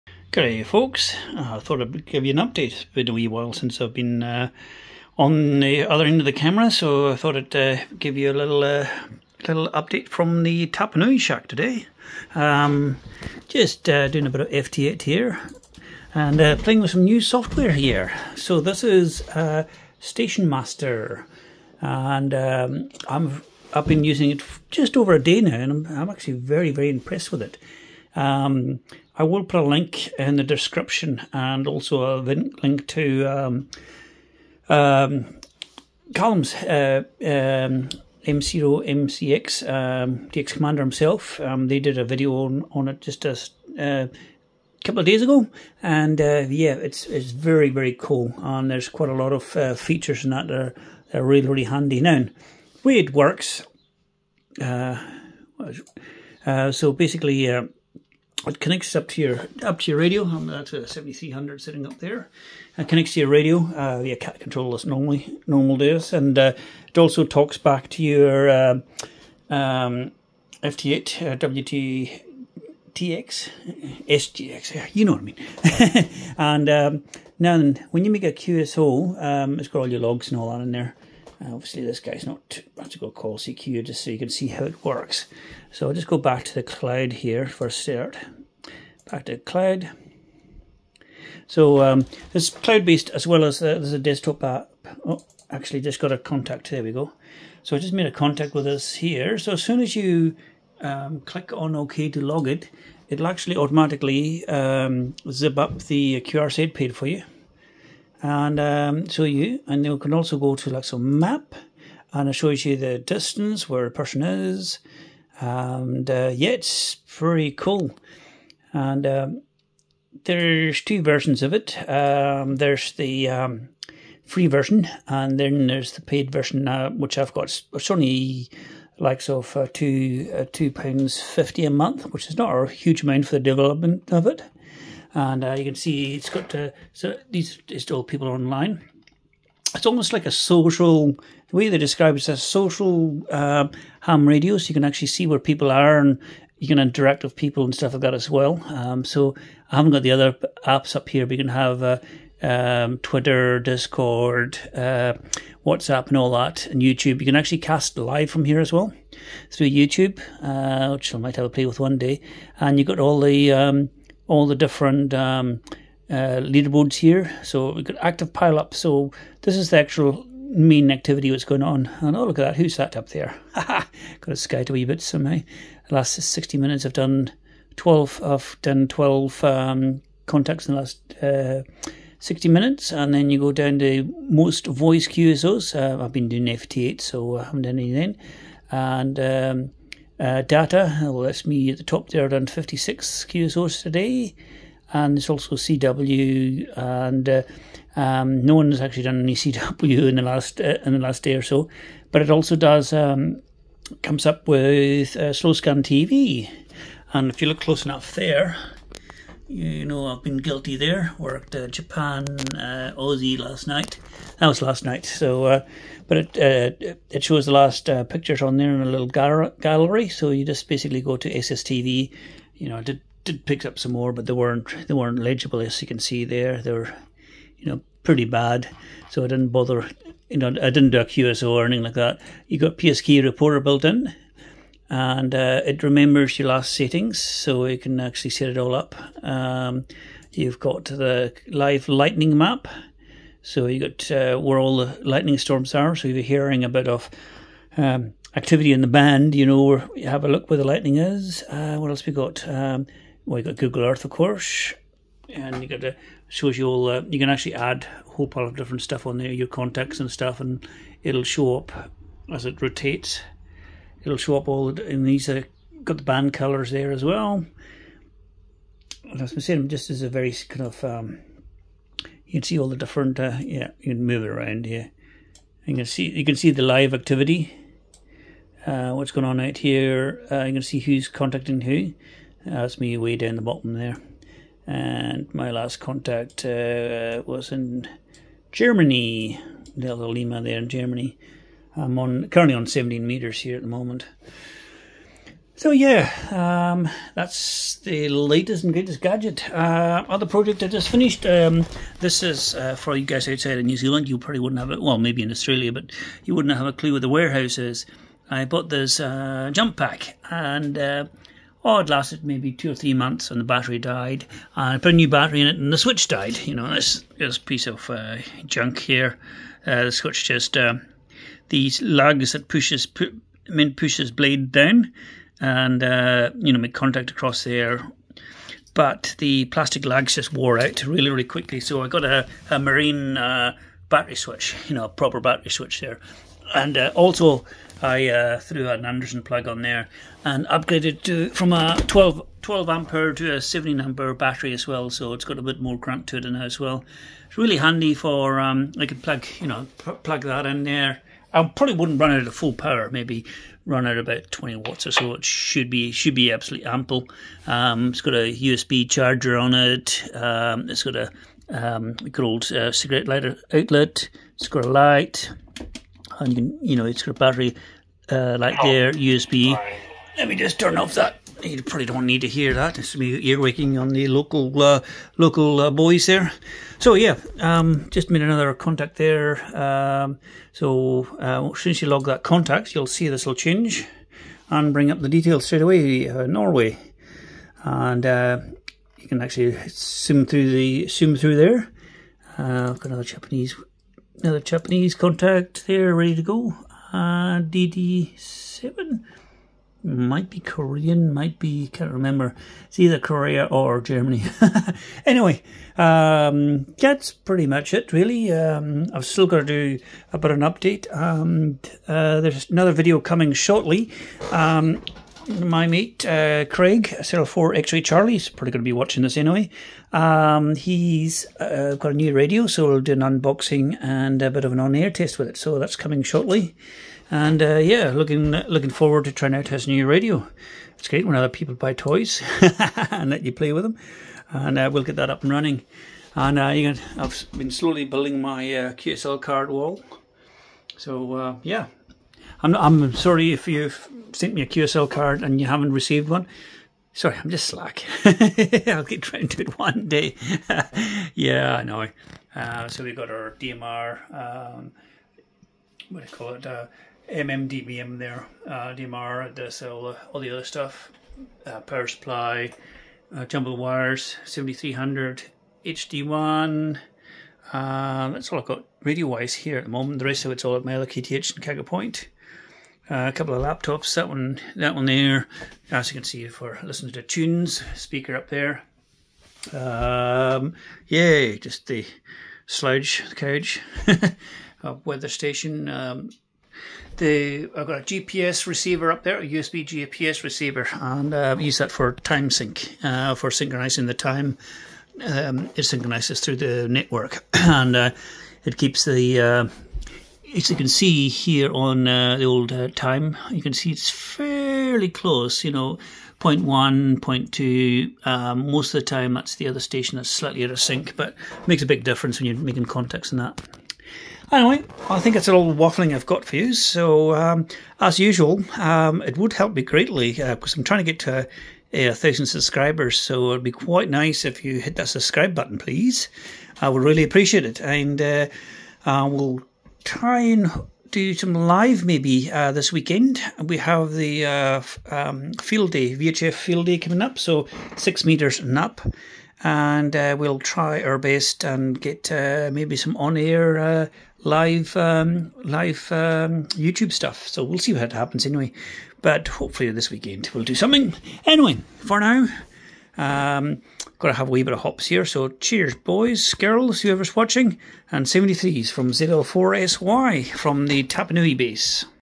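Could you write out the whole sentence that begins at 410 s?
Um, uh, there's another video coming shortly.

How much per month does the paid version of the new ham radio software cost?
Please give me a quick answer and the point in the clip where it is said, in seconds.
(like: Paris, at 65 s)
2 pounds 50, at 130 s.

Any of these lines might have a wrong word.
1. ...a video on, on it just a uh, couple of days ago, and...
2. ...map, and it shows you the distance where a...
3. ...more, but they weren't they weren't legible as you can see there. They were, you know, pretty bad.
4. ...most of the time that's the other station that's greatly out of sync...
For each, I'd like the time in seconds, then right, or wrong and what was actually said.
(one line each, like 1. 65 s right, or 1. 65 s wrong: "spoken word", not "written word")
1. 41 s right
2. 111 s right
3. 223 s right
4. 508 s wrong: "slightly", not "greatly".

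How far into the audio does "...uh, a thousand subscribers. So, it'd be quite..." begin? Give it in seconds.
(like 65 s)
521 s.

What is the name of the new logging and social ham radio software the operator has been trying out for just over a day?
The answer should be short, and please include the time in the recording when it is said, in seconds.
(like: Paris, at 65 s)
Station Master, at 19 s.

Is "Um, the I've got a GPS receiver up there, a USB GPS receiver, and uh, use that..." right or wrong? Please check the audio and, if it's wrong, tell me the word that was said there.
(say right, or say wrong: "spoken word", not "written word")
right.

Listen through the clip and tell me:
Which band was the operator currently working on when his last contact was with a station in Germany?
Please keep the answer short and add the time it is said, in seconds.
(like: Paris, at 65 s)
17 meters, at 292 s.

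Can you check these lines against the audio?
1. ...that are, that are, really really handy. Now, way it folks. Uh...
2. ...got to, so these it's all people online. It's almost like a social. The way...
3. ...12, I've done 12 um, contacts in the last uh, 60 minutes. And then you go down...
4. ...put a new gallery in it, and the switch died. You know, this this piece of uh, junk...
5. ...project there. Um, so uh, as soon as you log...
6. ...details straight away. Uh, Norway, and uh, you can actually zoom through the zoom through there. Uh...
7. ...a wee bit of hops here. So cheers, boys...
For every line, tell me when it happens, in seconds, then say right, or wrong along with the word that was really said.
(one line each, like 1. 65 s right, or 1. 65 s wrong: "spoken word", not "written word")
1. 50 s wrong: "works", not "folks"
2. 136 s right
3. 177 s right
4. 314 s wrong: "battery", not "gallery"
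5. 378 s wrong: "contact", not "project"
6. 385 s right
7. 554 s right.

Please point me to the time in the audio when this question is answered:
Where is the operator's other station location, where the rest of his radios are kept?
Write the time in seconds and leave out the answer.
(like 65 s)
471 s.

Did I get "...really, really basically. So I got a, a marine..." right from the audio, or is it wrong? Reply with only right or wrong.
wrong.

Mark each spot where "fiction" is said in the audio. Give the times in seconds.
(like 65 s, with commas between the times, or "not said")
not said.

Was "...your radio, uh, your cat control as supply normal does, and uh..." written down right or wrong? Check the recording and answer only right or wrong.
wrong.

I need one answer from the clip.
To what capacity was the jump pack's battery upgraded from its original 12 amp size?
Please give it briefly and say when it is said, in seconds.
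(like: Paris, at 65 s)
17 ampere, at 343 s.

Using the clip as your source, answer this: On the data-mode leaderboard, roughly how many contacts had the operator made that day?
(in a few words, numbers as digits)
56.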